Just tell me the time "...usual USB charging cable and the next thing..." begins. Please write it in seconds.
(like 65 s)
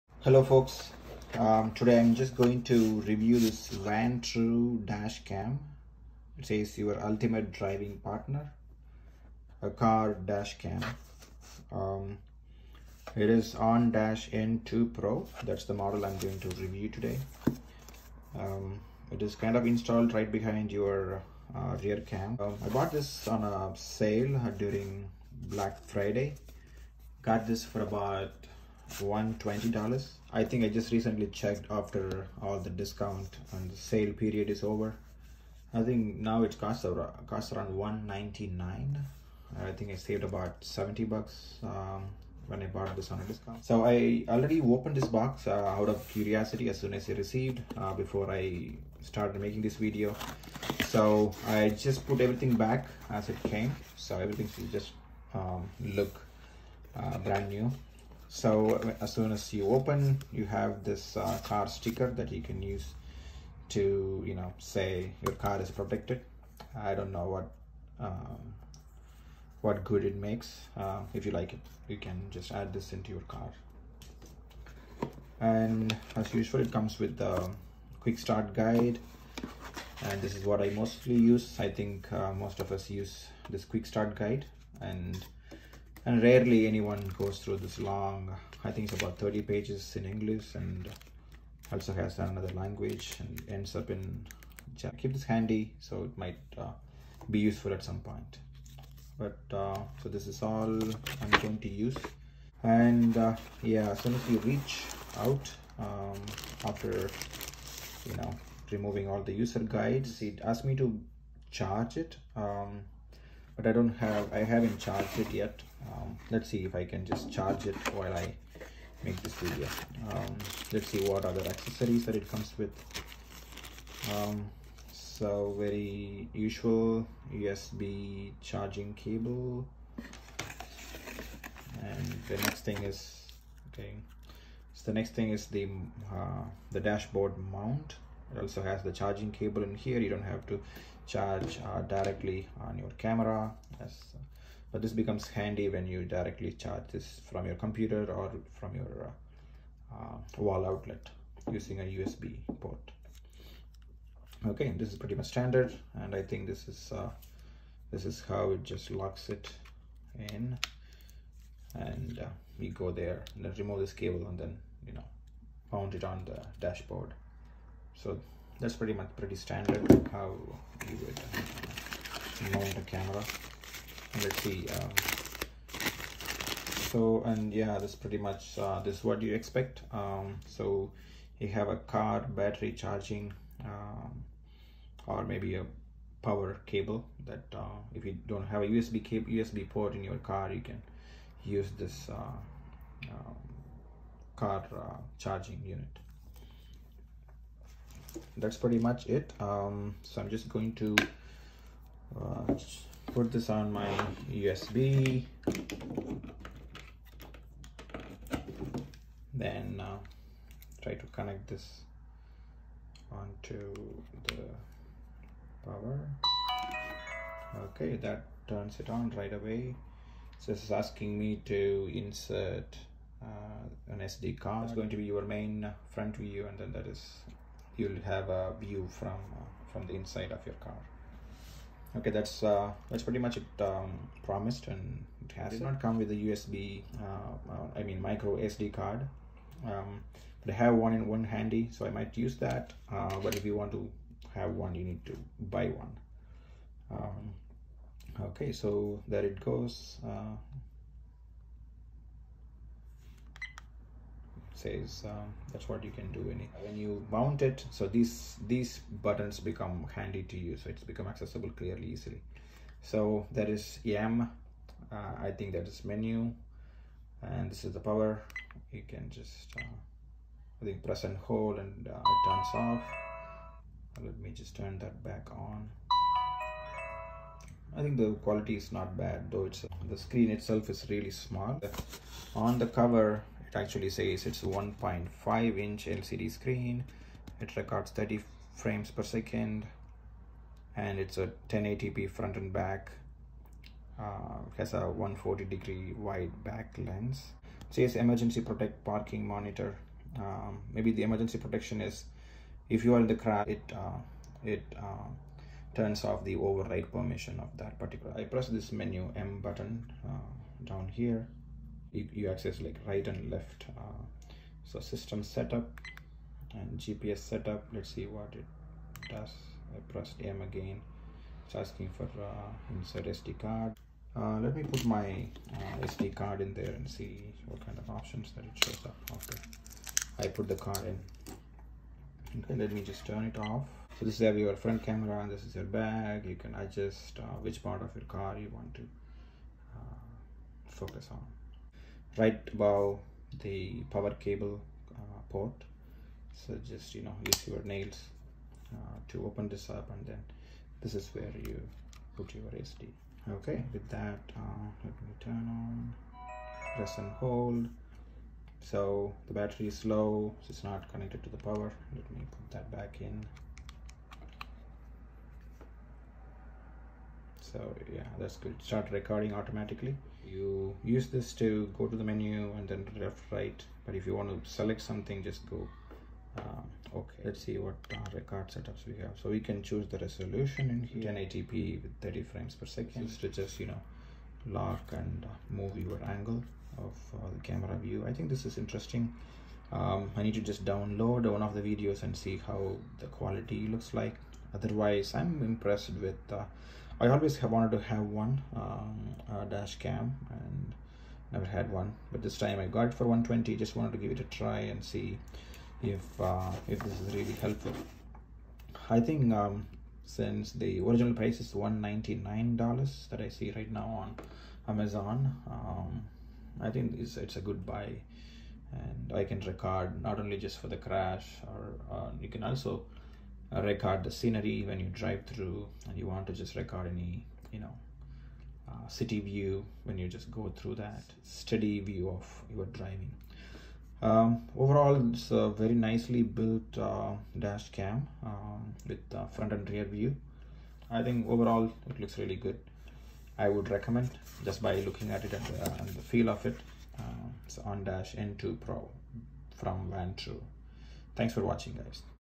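126 s.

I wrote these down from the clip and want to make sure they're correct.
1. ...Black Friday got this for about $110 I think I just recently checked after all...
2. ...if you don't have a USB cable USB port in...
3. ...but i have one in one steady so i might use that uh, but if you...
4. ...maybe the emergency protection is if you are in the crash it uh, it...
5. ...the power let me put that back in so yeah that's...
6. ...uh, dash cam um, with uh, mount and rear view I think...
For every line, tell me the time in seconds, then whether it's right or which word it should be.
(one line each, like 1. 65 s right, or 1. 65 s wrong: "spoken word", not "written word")
1. 25 s wrong: "120", not "110"
2. 187 s right
3. 240 s wrong: "handy", not "steady"
4. 300 s right
5. 361 s right
6. 436 s wrong: "front", not "mount".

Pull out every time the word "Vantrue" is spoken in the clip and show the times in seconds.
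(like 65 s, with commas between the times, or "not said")
3 s, 449 s.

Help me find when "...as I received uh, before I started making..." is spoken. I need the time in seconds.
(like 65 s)
46 s.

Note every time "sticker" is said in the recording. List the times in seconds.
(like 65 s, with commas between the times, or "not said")
61 s.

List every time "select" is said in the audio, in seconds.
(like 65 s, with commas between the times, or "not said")
374 s.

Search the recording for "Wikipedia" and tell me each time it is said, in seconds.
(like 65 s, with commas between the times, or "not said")
not said.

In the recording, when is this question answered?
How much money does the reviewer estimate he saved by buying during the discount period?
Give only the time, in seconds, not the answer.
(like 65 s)
40 s.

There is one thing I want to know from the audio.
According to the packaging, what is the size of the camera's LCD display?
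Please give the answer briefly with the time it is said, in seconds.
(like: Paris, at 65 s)
1.5 inch, at 284 s.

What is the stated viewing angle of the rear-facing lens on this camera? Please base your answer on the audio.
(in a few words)
140 degree.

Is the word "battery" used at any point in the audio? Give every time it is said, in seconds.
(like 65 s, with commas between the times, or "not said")
182 s, 359 s.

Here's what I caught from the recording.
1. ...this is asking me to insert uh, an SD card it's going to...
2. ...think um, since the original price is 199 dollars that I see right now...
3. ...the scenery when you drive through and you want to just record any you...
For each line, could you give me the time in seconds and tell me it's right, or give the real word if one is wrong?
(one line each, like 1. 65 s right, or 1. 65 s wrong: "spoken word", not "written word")
1. 220 s right
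2. 408 s right
3. 424 s right.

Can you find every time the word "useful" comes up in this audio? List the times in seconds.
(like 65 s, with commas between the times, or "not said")
97 s.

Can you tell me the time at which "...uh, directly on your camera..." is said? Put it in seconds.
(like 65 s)
141 s.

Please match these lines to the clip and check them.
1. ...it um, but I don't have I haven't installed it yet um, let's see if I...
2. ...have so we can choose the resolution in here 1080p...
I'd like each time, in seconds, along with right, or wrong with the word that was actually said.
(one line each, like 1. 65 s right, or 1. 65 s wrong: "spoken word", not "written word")
1. 111 s wrong: "charged", not "installed"
2. 379 s right.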